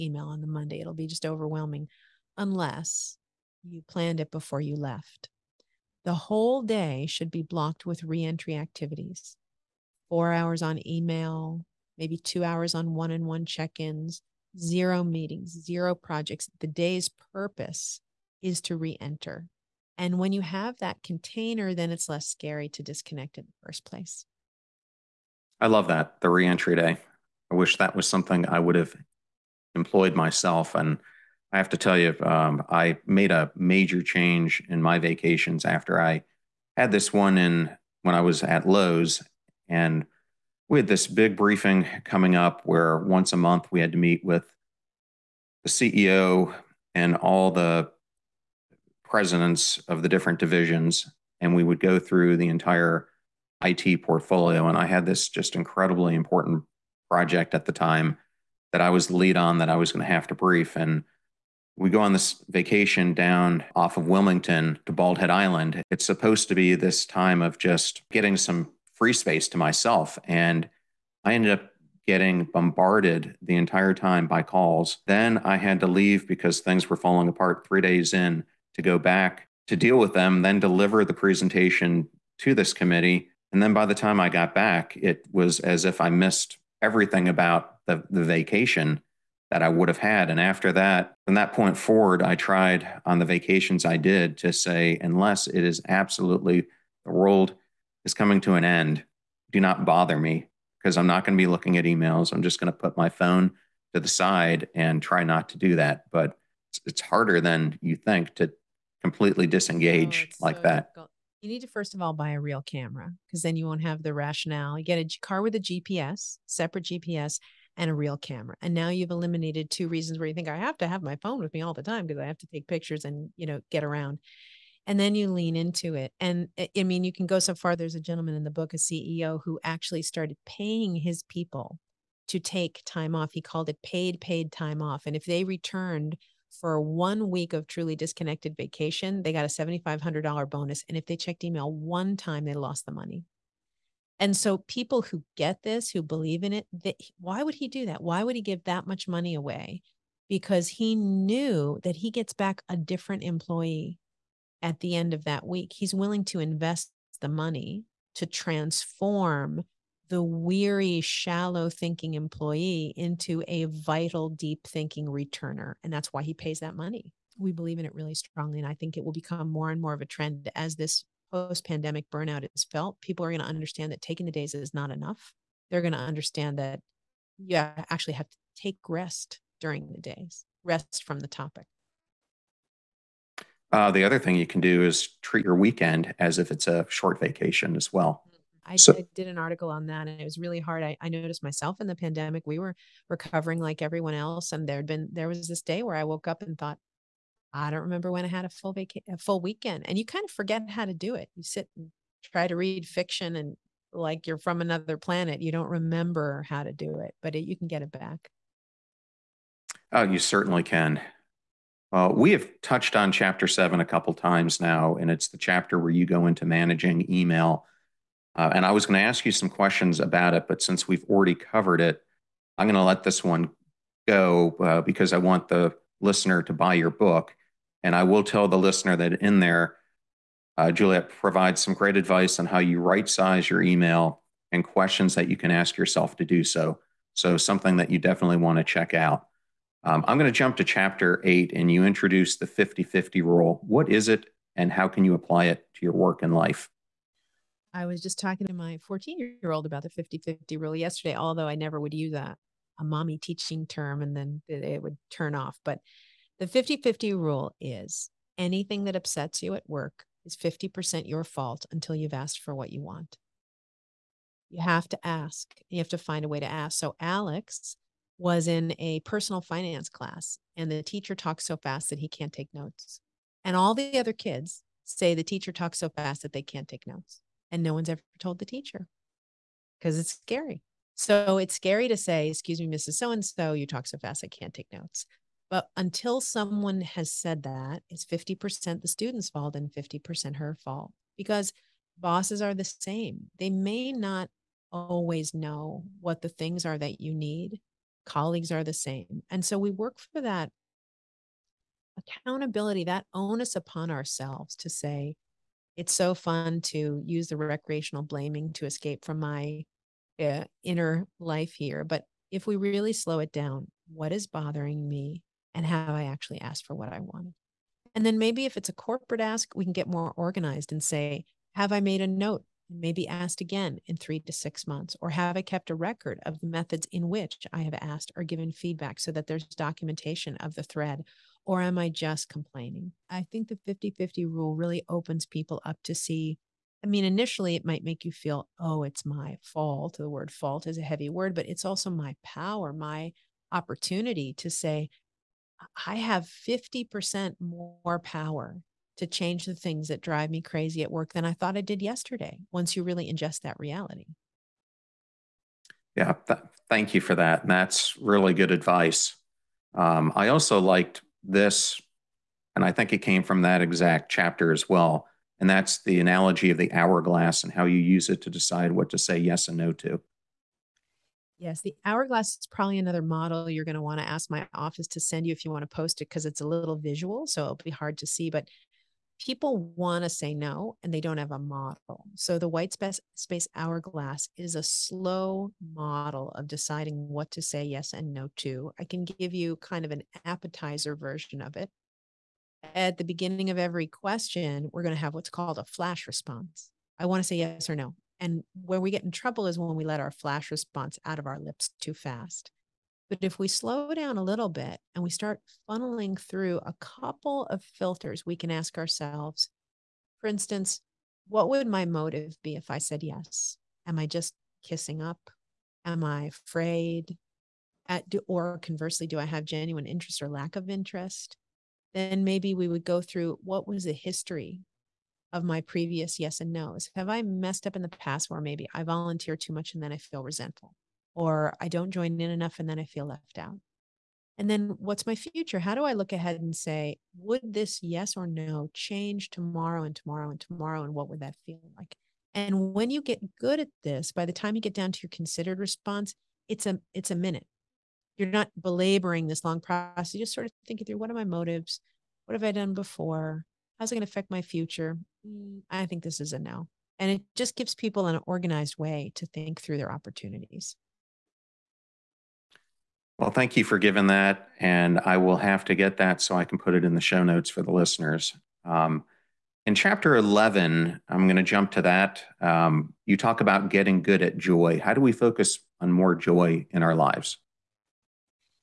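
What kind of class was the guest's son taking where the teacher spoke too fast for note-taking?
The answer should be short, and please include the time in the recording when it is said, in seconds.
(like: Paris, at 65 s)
Personal finance, at 269 s.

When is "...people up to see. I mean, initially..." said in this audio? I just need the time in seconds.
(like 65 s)
335 s.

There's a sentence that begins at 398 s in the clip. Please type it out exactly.
And where we get in trouble is when we let our flash response out of our lips too fast.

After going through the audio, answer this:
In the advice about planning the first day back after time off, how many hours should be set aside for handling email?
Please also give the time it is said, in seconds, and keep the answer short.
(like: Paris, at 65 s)
4, at 10 s.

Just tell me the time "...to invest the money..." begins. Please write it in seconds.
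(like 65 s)
156 s.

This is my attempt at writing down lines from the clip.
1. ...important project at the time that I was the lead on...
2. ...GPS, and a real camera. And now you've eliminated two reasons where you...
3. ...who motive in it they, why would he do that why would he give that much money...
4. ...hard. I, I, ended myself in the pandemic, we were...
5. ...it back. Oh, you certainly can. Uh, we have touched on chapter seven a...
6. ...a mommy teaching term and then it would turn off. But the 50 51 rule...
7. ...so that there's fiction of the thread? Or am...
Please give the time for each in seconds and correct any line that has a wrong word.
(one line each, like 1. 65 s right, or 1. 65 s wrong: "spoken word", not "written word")
1. 56 s right
2. 116 s right
3. 145 s wrong: "believe", not "motive"
4. 190 s wrong: "noticed", not "ended"
5. 207 s right
6. 252 s wrong: "50", not "51"
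7. 328 s wrong: "documentation", not "fiction".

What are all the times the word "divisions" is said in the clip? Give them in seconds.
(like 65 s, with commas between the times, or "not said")
50 s.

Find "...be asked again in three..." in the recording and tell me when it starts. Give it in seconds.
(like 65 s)
322 s.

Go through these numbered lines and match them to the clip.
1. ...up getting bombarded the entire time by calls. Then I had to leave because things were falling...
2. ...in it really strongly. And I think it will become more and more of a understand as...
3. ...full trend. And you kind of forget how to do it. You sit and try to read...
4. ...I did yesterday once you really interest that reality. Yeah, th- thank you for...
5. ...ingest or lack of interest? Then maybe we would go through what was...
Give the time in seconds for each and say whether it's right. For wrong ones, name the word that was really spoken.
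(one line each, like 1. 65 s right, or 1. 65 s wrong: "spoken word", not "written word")
1. 71 s right
2. 167 s wrong: "trend", not "understand"
3. 199 s wrong: "weekend", not "trend"
4. 351 s wrong: "ingest", not "interest"
5. 419 s wrong: "interest", not "ingest".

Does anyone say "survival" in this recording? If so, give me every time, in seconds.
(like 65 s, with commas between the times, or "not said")
not said.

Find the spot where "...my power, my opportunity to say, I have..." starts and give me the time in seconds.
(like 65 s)
341 s.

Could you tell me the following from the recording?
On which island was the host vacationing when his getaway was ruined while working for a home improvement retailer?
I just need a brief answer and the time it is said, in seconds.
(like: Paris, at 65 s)
Bald Head Island, at 64 s.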